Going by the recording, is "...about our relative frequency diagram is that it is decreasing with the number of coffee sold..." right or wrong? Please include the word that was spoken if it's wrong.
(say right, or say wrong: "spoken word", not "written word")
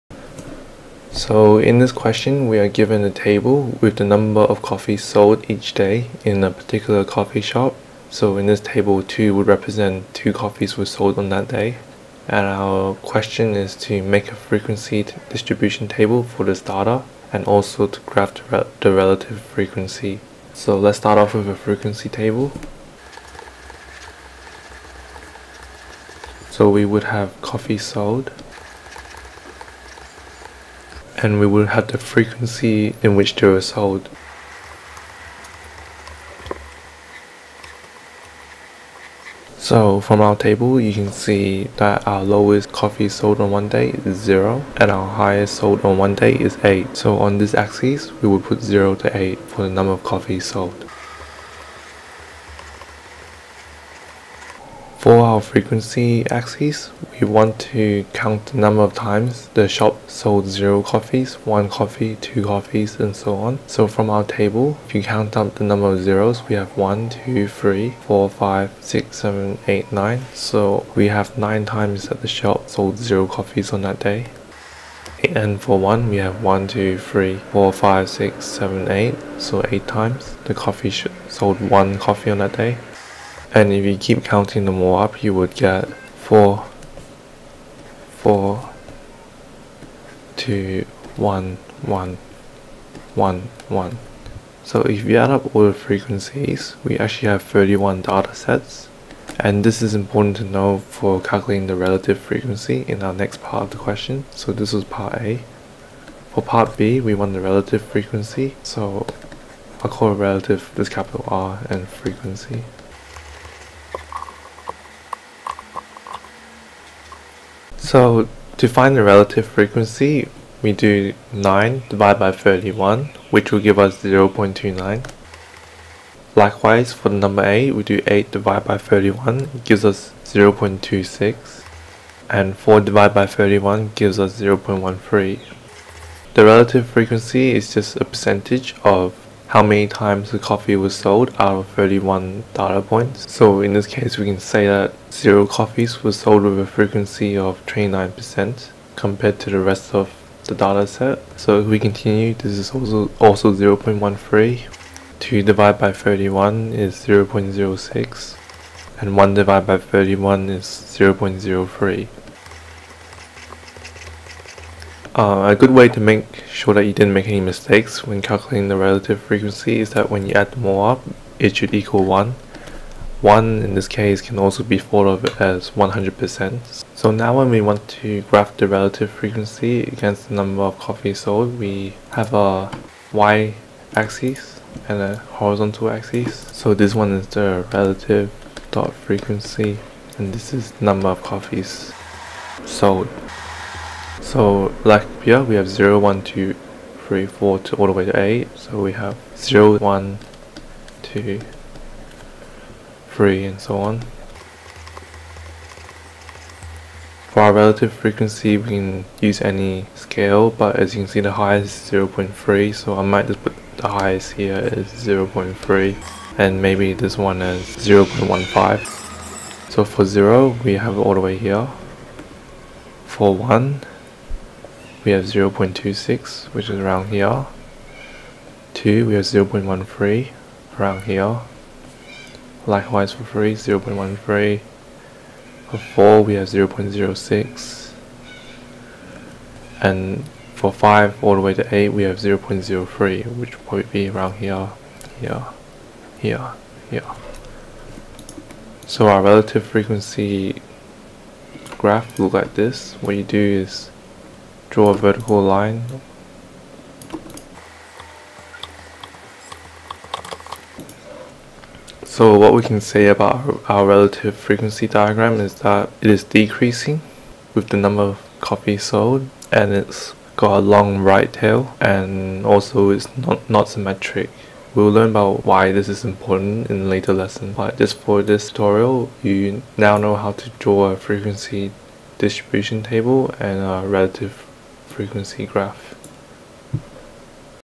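right.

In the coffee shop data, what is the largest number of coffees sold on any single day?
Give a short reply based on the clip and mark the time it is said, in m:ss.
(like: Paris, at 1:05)
8, at 0:44.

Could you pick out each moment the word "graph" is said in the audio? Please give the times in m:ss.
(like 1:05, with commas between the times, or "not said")
0:18, 2:58, 4:11, 4:45.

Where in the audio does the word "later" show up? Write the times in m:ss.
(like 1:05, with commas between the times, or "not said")
4:36.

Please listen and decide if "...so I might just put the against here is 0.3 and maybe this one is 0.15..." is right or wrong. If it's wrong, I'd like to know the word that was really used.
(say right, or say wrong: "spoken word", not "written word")
wrong: "highest", not "against".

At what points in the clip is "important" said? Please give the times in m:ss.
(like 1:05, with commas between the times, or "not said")
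1:39, 4:36.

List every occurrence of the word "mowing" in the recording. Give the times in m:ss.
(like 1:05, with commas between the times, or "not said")
not said.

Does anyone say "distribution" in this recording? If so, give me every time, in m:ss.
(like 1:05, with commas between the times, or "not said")
0:15, 4:42.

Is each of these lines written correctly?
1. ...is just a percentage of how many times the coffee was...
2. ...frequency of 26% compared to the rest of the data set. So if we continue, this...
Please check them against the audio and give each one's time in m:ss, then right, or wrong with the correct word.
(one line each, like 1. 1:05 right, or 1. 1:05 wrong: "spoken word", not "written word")
1. 2:17 right
2. 2:26 wrong: "29", not "26".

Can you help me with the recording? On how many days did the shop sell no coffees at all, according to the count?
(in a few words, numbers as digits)
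9.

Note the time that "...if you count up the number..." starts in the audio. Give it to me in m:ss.
1:04.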